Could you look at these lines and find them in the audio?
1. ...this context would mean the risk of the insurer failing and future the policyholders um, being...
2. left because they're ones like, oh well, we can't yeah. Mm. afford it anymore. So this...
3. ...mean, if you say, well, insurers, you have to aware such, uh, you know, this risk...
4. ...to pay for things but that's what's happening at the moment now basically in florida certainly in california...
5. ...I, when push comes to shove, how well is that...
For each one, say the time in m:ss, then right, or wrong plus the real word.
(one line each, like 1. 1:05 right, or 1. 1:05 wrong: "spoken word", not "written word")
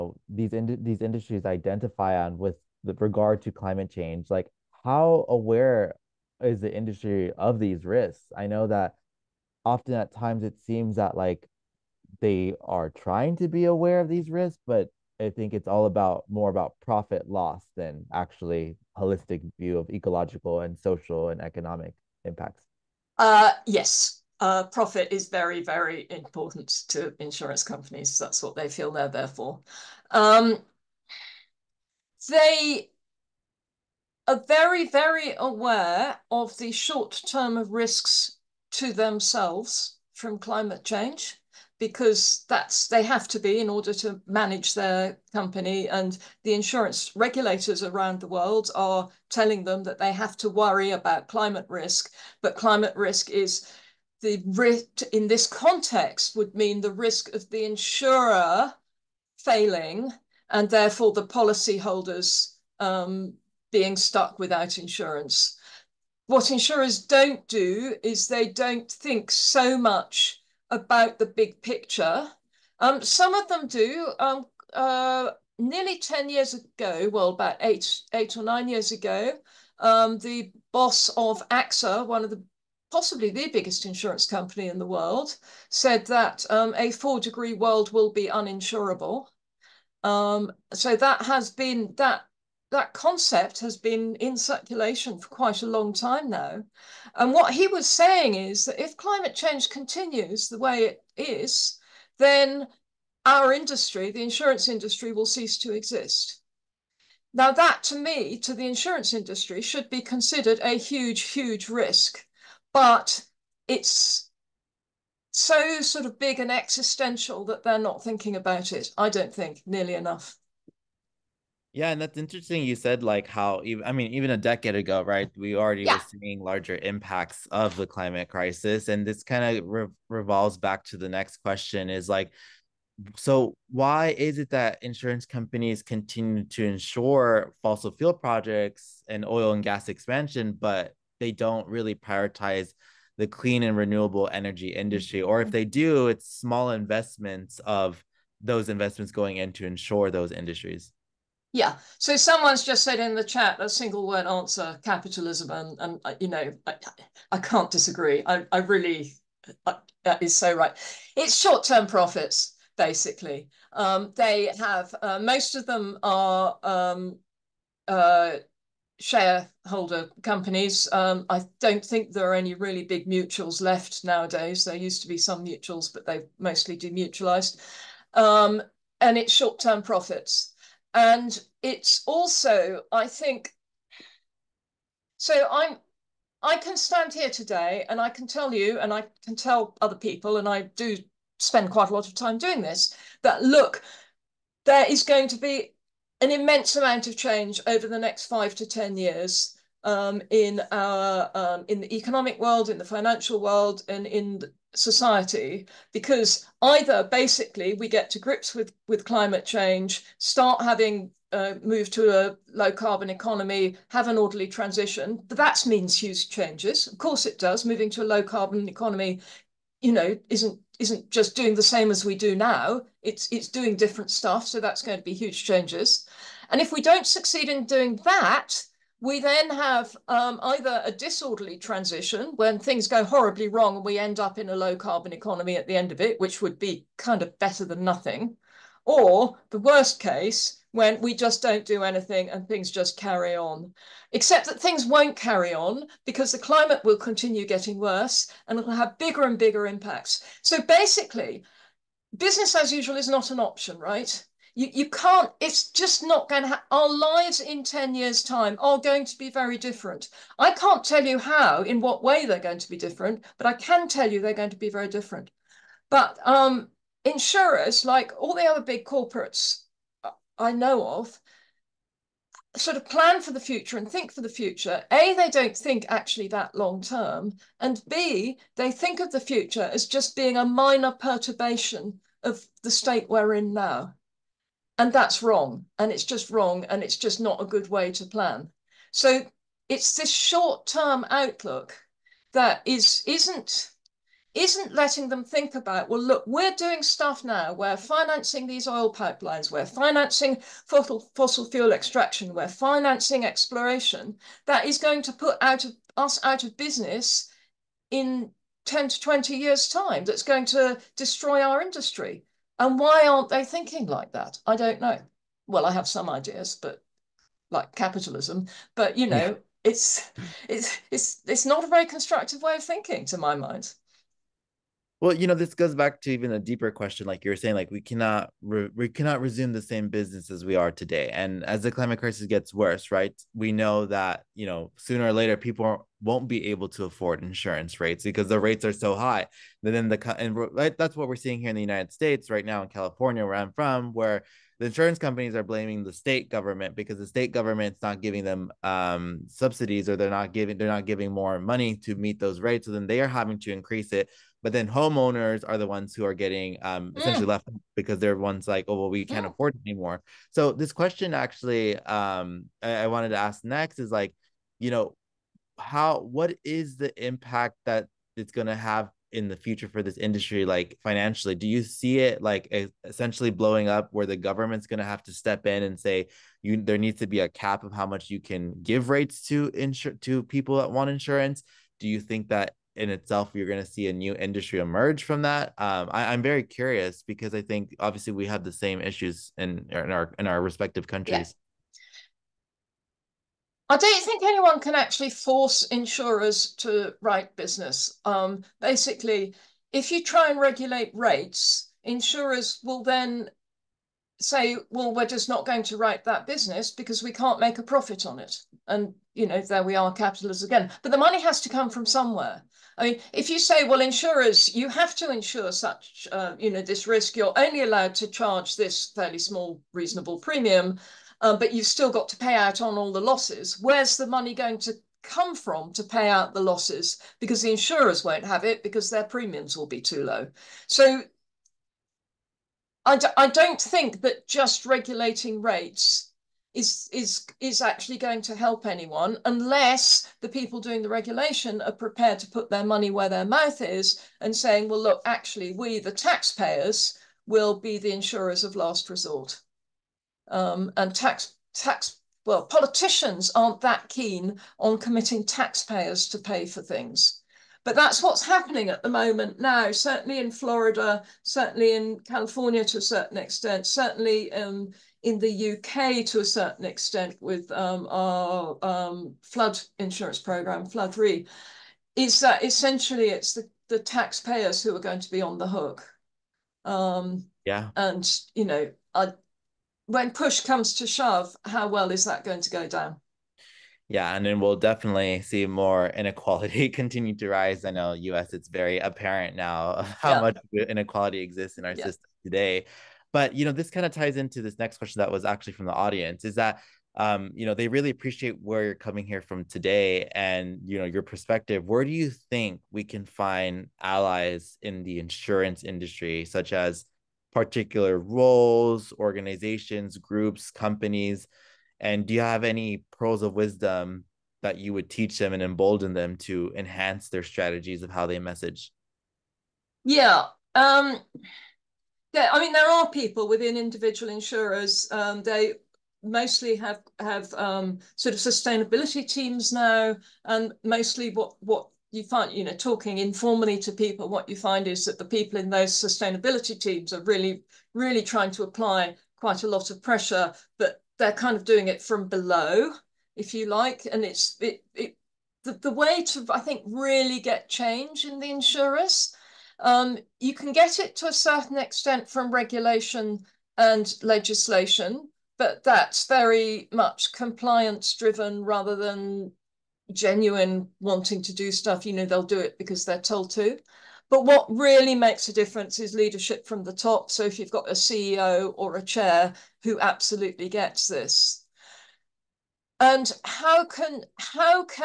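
1. 0:55 wrong: "therefore", not "future"
2. 5:57 right
3. 6:52 wrong: "insure", not "aware"
4. 7:36 wrong: "certainly", not "basically"
5. 7:58 right.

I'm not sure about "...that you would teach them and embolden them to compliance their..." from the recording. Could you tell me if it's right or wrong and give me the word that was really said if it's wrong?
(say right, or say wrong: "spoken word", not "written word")
wrong: "enhance", not "compliance".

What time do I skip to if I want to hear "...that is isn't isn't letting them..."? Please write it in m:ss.
4:52.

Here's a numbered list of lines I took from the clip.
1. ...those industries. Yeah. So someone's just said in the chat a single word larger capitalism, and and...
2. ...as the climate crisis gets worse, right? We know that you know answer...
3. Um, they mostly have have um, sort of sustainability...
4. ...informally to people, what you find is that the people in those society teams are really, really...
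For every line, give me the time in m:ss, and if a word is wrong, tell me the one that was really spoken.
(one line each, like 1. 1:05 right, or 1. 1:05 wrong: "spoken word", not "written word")
1. 2:30 wrong: "answer", not "larger"
2. 5:31 wrong: "sooner", not "answer"
3. 8:44 right
4. 8:52 wrong: "sustainability", not "society".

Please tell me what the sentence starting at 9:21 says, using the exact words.
You know, they'll do it because they're told to.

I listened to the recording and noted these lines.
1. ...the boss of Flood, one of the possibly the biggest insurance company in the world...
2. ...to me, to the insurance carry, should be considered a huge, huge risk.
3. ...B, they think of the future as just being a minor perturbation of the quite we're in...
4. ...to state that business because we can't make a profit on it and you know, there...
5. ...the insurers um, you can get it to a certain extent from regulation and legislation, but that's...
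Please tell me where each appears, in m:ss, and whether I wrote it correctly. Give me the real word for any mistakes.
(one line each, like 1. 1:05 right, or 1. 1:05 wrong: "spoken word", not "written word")
1. 1:20 wrong: "AXA", not "Flood"
2. 1:47 wrong: "industry", not "carry"
3. 4:37 wrong: "state", not "quite"
4. 6:45 wrong: "write", not "state"
5. 9:08 right.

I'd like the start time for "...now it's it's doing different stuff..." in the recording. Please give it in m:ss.
3:42.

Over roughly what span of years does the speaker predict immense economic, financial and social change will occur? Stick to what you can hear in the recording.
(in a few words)
5 to 10 years.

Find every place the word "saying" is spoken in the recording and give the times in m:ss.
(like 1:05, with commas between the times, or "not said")
1:37, 5:27, 7:24.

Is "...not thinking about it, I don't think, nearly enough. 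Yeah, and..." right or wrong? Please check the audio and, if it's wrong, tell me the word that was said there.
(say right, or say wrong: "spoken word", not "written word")
right.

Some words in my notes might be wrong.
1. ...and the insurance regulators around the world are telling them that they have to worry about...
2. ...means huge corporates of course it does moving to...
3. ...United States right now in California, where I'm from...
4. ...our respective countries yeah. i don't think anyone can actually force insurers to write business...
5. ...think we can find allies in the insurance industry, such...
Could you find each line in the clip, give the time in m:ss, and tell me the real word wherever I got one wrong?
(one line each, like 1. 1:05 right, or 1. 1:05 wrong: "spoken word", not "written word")
1. 0:45 right
2. 3:35 wrong: "changes", not "corporates"
3. 5:41 right
4. 6:30 right
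5. 8:22 right.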